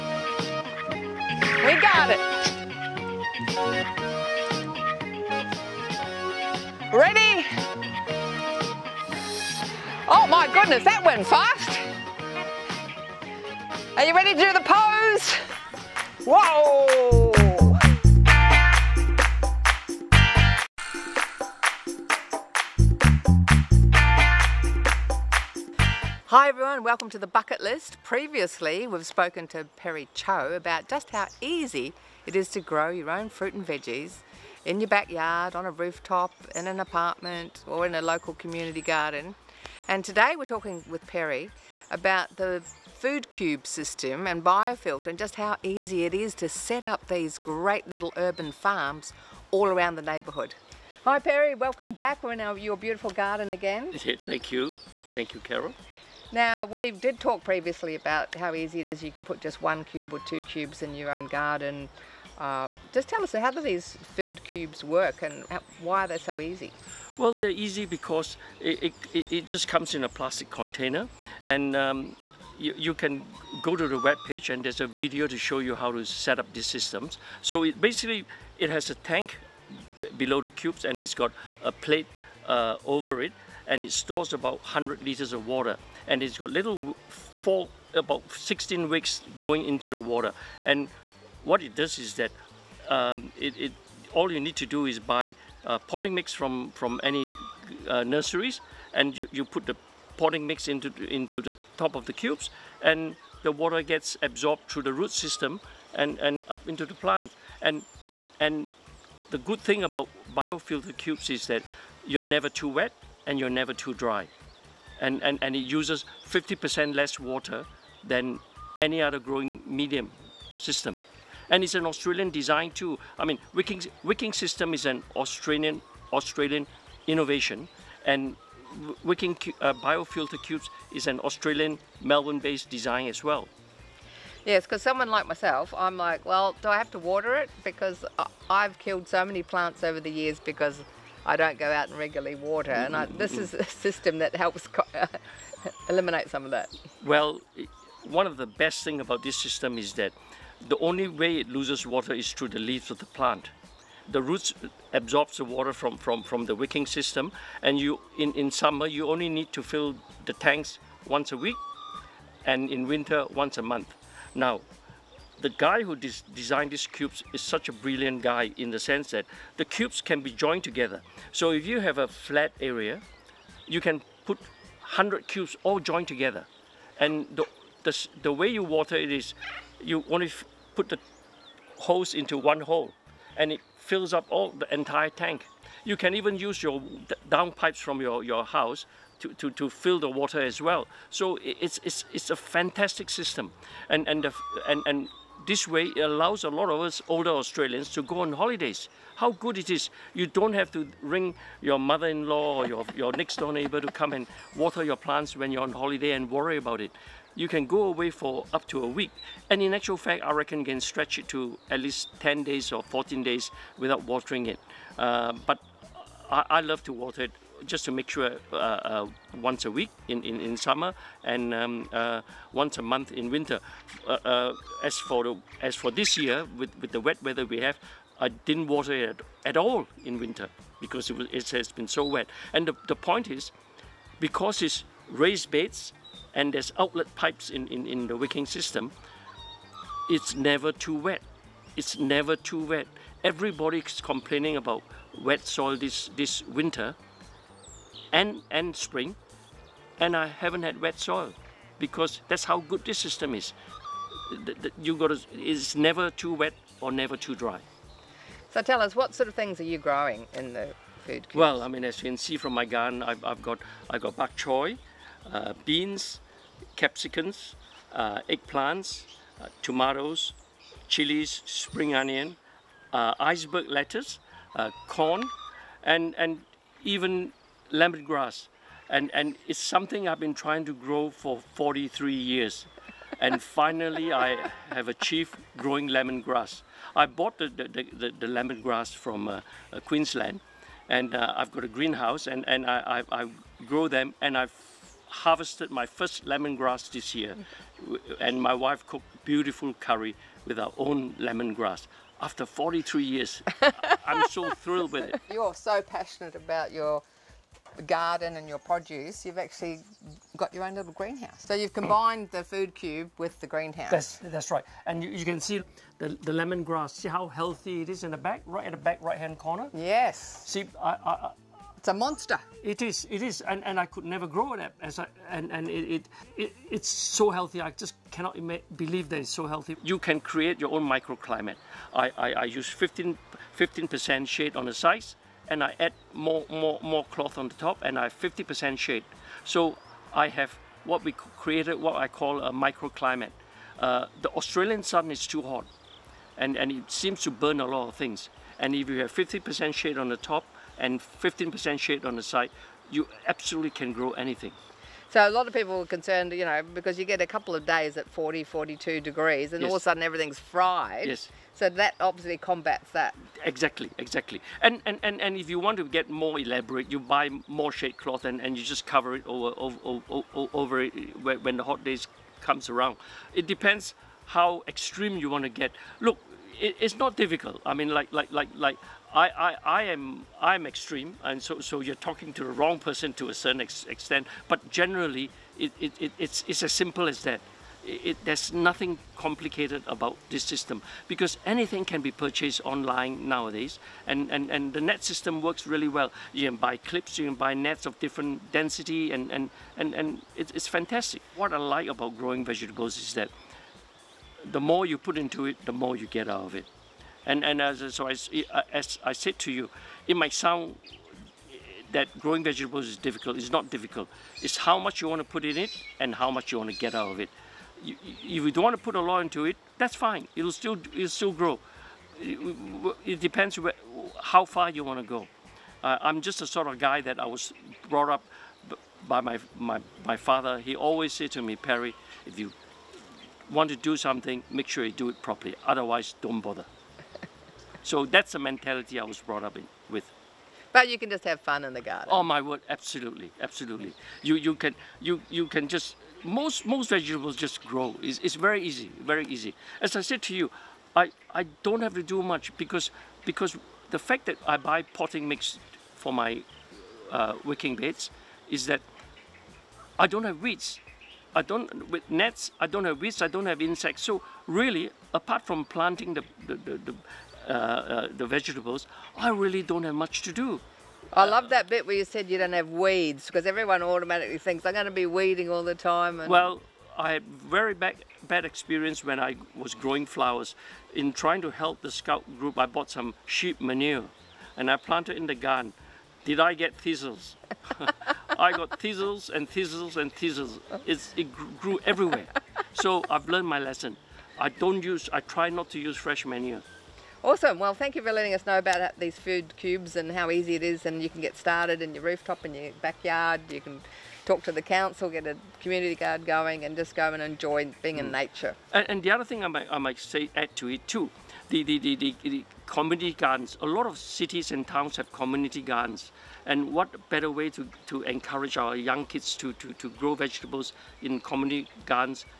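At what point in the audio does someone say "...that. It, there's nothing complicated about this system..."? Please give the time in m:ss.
6:27.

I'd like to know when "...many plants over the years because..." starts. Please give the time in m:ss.
2:19.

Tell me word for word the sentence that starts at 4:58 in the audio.
And my wife cooked beautiful curry with our own lemongrass after 43 years.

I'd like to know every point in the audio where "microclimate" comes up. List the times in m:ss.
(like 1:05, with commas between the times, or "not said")
5:30, 5:42.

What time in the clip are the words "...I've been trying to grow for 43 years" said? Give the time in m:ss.
4:40.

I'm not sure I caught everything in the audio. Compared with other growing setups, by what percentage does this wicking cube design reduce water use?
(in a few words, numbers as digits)
50%.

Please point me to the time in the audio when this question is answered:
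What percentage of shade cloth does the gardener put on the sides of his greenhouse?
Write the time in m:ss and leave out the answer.
5:32.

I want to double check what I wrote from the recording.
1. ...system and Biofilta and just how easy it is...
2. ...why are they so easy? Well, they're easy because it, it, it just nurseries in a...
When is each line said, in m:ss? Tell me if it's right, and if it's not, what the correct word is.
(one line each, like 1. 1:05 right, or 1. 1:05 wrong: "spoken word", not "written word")
1. 0:43 right
2. 1:05 wrong: "comes", not "nurseries".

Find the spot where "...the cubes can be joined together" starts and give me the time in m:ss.
2:49.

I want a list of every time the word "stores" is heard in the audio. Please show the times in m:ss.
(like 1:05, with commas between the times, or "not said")
1:23.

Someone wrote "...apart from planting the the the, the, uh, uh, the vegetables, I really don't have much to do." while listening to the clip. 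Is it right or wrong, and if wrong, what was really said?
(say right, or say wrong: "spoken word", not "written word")
right.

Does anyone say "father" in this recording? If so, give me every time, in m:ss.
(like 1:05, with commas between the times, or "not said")
7:10.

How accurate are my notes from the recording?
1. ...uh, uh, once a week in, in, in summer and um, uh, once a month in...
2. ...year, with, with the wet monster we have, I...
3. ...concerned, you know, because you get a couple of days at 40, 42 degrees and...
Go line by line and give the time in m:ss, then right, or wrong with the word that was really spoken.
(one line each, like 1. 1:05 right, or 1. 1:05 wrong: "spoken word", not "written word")
1. 3:38 right
2. 3:46 wrong: "weather", not "monster"
3. 5:55 right.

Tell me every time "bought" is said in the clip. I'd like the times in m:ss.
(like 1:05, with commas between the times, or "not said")
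4:47, 8:02.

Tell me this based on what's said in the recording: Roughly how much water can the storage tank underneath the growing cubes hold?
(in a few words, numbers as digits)
100 liters.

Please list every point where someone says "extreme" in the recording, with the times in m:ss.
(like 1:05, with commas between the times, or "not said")
6:14, 6:20.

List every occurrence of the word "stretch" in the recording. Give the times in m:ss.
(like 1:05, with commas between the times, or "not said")
3:30.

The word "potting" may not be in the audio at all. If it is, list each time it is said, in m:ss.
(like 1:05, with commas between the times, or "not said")
1:35, 1:40, 7:34.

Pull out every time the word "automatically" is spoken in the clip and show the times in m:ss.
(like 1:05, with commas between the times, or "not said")
7:53.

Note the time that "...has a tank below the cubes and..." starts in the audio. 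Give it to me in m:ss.
1:18.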